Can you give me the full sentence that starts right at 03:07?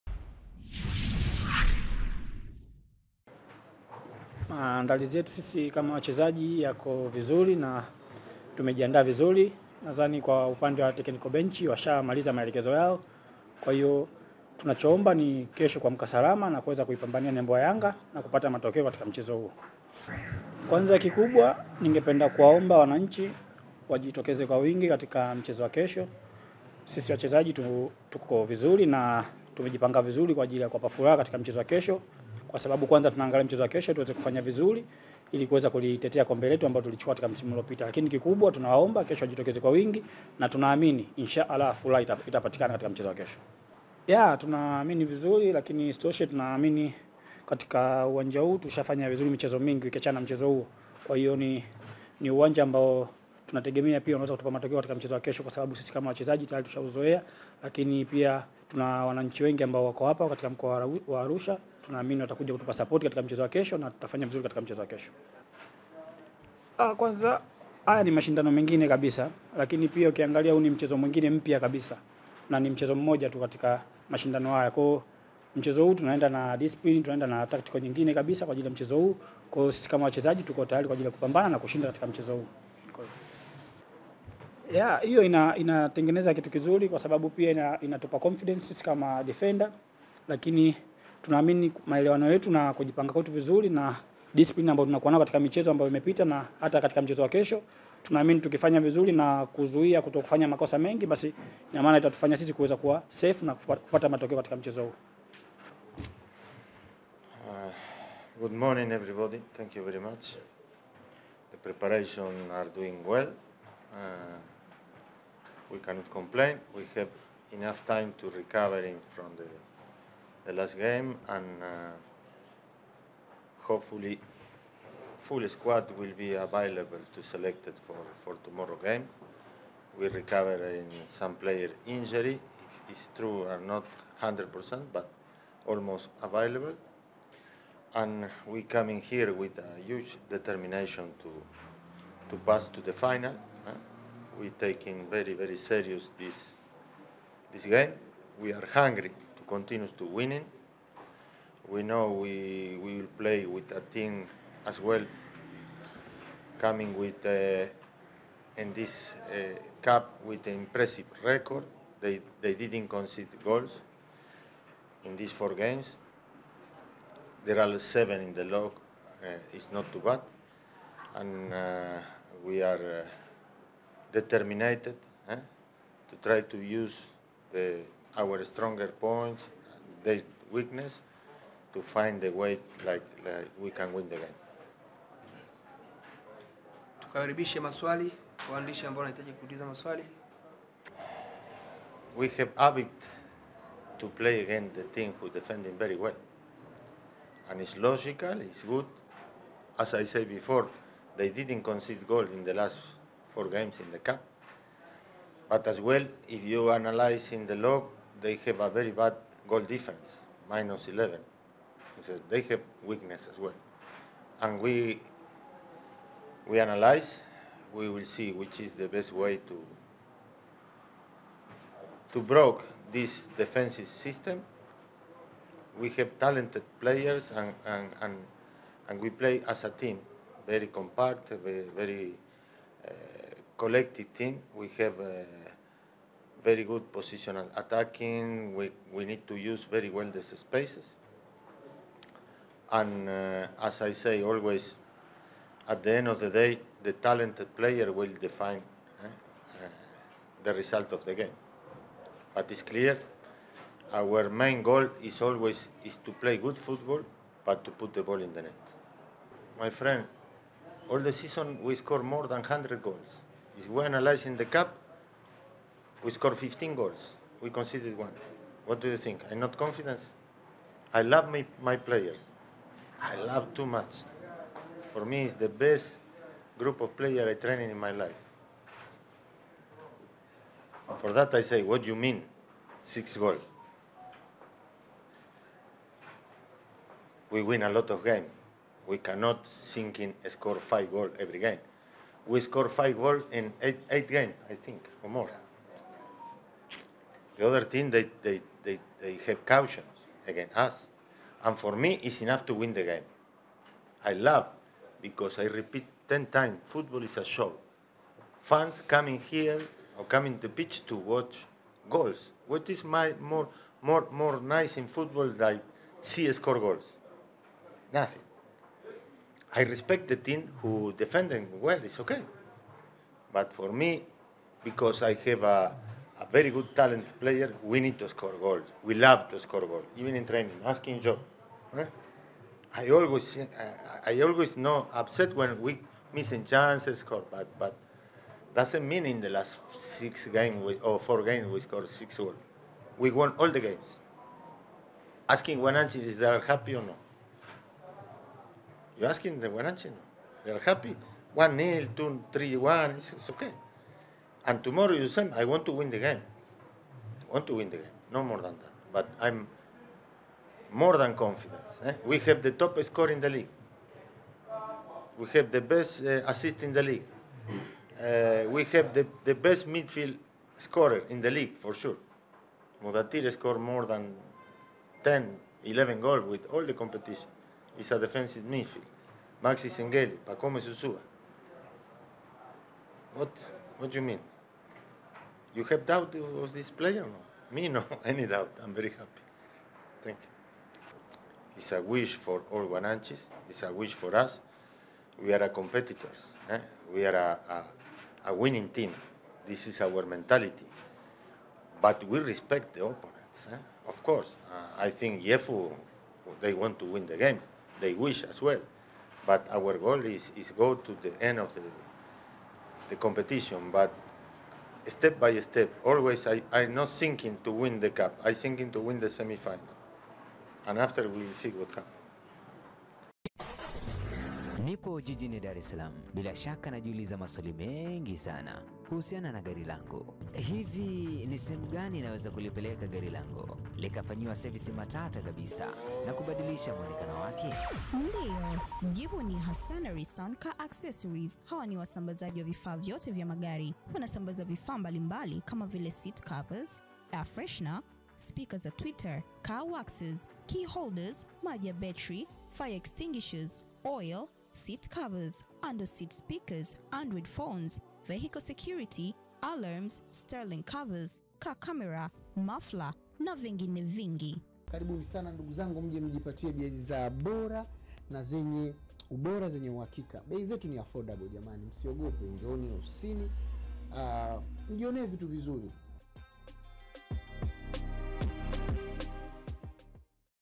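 Tukaribishe maswali waandishi ambao wanahitaji kuuliza maswali.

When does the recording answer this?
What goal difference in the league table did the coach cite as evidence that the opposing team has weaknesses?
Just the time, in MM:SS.
03:30.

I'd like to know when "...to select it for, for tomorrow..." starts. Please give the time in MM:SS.
02:07.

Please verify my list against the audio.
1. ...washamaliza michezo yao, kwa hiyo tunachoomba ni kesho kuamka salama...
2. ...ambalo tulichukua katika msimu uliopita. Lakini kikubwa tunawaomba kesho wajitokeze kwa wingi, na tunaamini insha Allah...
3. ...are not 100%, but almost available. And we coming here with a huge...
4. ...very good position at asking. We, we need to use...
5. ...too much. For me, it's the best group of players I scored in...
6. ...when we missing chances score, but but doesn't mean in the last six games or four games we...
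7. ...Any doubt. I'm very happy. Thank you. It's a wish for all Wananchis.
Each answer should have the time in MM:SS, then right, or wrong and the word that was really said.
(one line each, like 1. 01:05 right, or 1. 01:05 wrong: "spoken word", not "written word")
1. 00:11 wrong: "maelekezo", not "michezo"
2. 00:36 right
3. 02:13 right
4. 03:56 wrong: "attacking", not "asking"
5. 04:33 wrong: "trained", not "scored"
6. 05:35 right
7. 06:28 right.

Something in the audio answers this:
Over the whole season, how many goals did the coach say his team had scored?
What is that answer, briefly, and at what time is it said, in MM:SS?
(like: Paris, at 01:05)
more than 100, at 04:22.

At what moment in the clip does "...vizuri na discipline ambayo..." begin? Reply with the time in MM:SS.
01:33.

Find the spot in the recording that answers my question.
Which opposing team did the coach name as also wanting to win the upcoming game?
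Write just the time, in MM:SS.
06:45.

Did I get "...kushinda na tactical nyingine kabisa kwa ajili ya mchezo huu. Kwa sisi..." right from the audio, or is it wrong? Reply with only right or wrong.
wrong.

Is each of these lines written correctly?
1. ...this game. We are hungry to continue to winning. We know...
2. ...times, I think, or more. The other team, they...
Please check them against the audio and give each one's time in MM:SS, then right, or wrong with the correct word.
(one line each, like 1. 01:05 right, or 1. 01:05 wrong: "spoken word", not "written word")
1. 02:27 right
2. 04:54 wrong: "games", not "times".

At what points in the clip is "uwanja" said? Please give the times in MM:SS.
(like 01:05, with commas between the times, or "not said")
00:48, 00:52.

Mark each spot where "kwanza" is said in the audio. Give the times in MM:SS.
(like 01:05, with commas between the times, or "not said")
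00:20, 00:32, 01:06.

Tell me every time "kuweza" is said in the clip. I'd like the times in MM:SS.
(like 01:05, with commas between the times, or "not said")
00:16, 00:35, 01:42.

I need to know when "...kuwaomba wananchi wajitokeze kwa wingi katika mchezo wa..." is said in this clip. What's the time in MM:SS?
00:22.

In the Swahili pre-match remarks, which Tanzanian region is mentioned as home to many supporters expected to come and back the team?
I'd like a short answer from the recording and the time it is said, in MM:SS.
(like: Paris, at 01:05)
Arusha, at 01:01.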